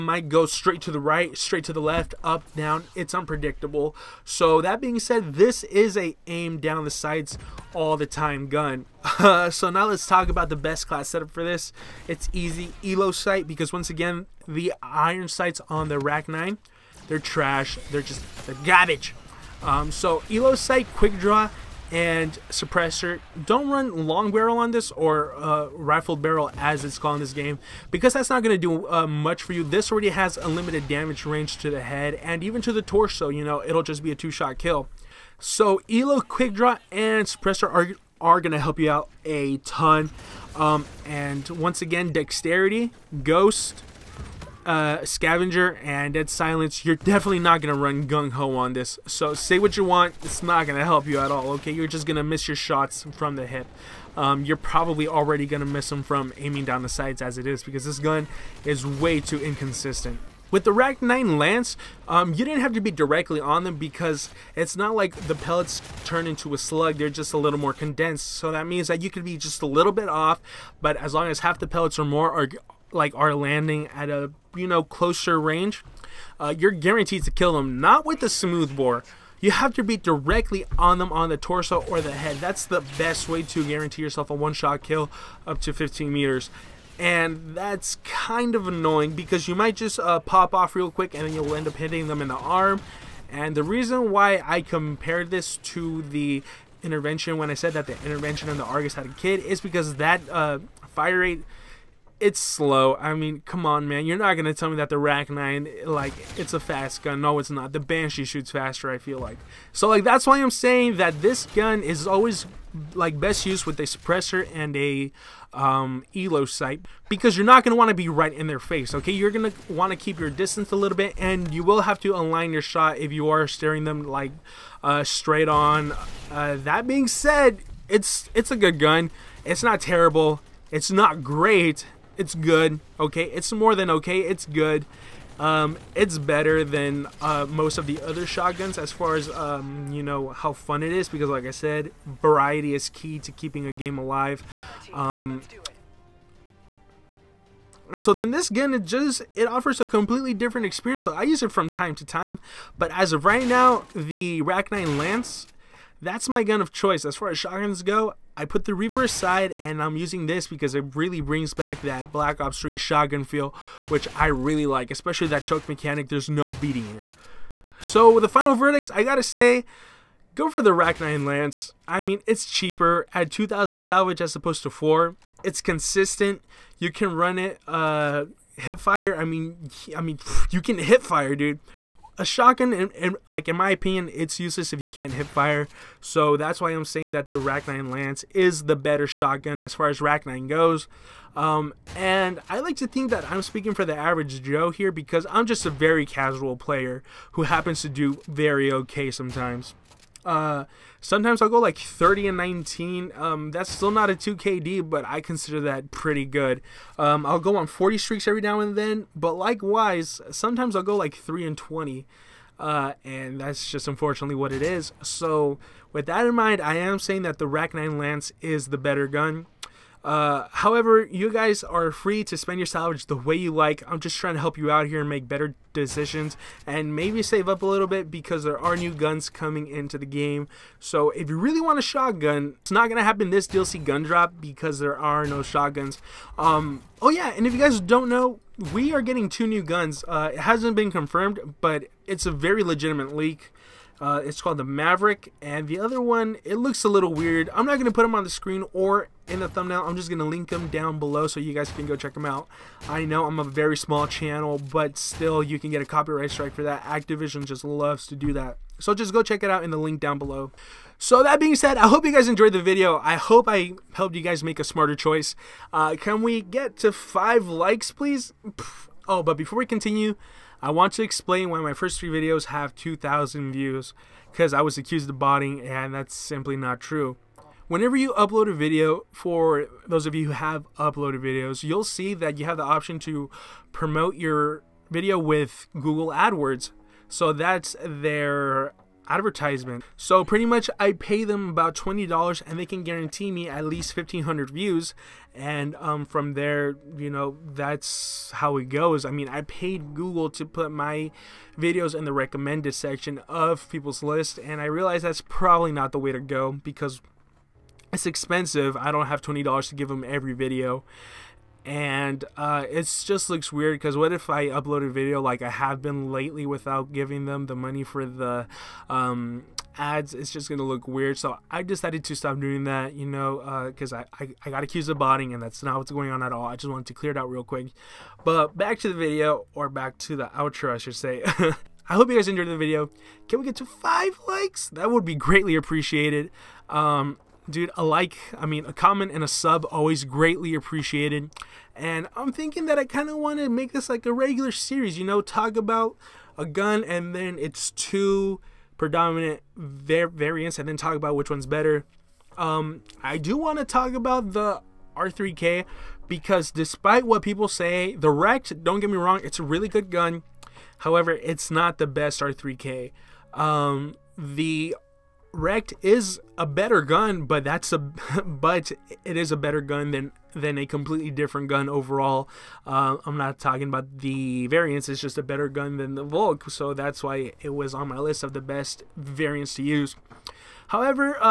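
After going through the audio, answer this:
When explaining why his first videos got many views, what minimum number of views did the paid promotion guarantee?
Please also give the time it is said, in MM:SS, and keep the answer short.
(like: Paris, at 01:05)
1500, at 04:53.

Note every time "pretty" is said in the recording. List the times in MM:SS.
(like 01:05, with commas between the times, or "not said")
03:25, 04:50.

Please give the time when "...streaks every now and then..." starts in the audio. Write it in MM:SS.
03:27.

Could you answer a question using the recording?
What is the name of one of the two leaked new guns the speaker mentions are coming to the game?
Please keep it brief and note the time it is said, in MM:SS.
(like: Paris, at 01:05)
Maverick, at 04:04.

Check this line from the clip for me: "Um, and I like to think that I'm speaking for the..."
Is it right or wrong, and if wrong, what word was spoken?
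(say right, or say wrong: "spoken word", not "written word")
right.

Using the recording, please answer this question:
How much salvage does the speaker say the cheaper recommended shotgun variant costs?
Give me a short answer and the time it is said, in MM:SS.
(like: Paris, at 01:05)
2,000, at 02:53.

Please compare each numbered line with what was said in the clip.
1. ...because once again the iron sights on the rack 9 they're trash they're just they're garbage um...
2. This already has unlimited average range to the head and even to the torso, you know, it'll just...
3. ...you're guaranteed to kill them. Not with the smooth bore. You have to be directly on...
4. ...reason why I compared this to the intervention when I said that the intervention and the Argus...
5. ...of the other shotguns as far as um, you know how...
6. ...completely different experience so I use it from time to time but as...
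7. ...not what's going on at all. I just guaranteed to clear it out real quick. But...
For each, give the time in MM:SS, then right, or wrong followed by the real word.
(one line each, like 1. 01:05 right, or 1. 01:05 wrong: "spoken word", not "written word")
1. 00:13 right
2. 00:29 wrong: "damage", not "average"
3. 01:16 right
4. 01:33 right
5. 02:17 right
6. 02:29 right
7. 05:25 wrong: "wanted", not "guaranteed".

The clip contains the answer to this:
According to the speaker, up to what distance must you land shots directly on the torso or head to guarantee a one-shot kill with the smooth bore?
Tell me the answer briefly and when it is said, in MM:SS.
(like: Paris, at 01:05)
15 meters, at 01:25.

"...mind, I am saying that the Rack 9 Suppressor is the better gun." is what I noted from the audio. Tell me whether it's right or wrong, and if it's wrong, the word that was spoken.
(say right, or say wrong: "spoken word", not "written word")
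wrong: "Lance", not "Suppressor".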